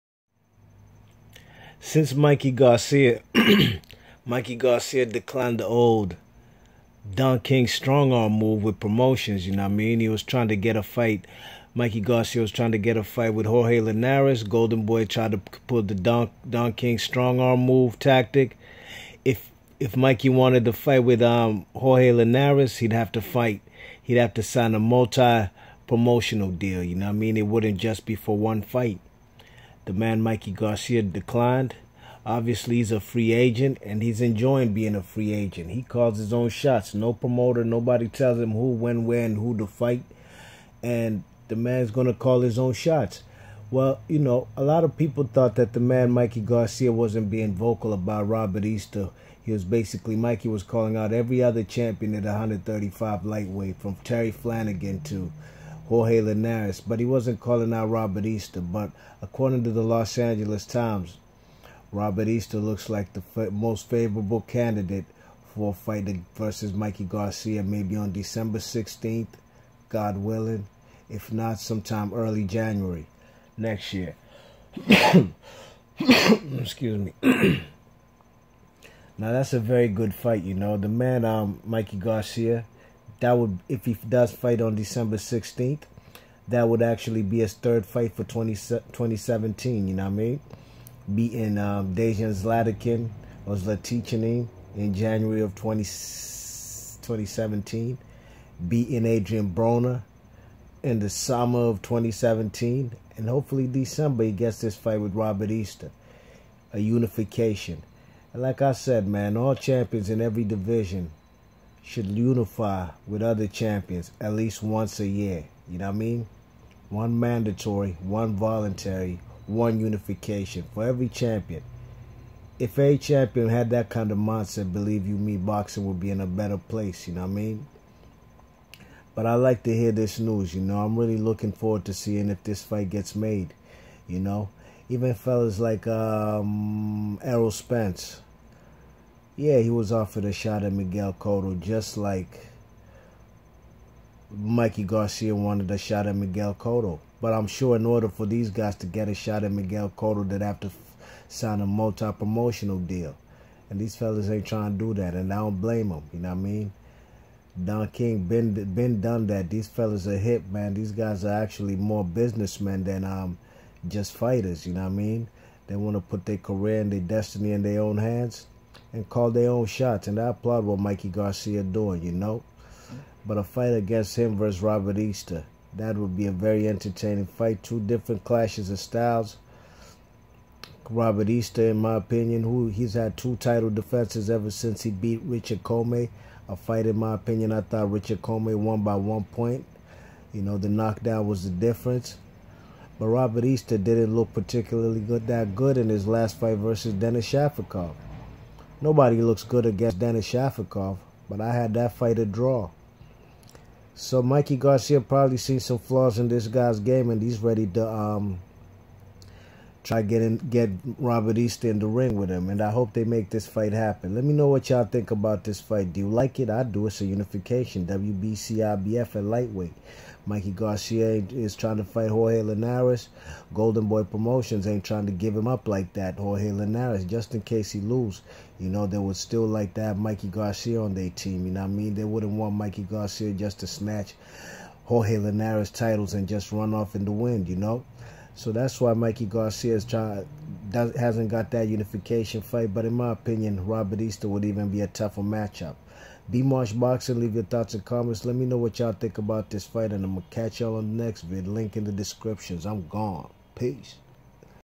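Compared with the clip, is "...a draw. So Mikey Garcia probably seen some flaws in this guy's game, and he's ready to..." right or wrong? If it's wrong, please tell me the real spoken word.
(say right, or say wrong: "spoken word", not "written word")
right.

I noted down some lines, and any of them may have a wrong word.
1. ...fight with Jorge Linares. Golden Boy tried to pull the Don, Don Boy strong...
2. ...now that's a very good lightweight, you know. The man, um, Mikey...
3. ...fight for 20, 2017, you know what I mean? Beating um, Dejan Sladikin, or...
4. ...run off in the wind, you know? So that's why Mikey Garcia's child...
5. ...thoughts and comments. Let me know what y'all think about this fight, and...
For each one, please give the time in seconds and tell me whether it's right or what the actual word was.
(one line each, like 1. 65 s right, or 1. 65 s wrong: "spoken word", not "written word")
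1. 13 s wrong: "King", not "Boy"
2. 79 s wrong: "fight", not "lightweight"
3. 87 s right
4. 236 s right
5. 247 s right.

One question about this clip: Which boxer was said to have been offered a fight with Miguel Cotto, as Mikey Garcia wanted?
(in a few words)
Errol Spence.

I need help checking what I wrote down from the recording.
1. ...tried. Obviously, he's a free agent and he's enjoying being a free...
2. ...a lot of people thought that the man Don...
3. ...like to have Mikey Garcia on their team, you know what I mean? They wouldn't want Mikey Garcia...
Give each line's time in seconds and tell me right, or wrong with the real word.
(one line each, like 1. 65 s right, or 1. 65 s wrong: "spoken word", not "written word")
1. 31 s wrong: "declined", not "tried"
2. 44 s wrong: "Mikey", not "Don"
3. 229 s right.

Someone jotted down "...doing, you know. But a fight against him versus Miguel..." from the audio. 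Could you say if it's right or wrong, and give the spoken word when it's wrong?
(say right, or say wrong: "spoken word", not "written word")
wrong: "Robert", not "Miguel".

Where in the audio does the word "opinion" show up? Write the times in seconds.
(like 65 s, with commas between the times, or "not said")
181 s, 187 s, 243 s.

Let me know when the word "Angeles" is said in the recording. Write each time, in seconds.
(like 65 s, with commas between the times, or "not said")
60 s.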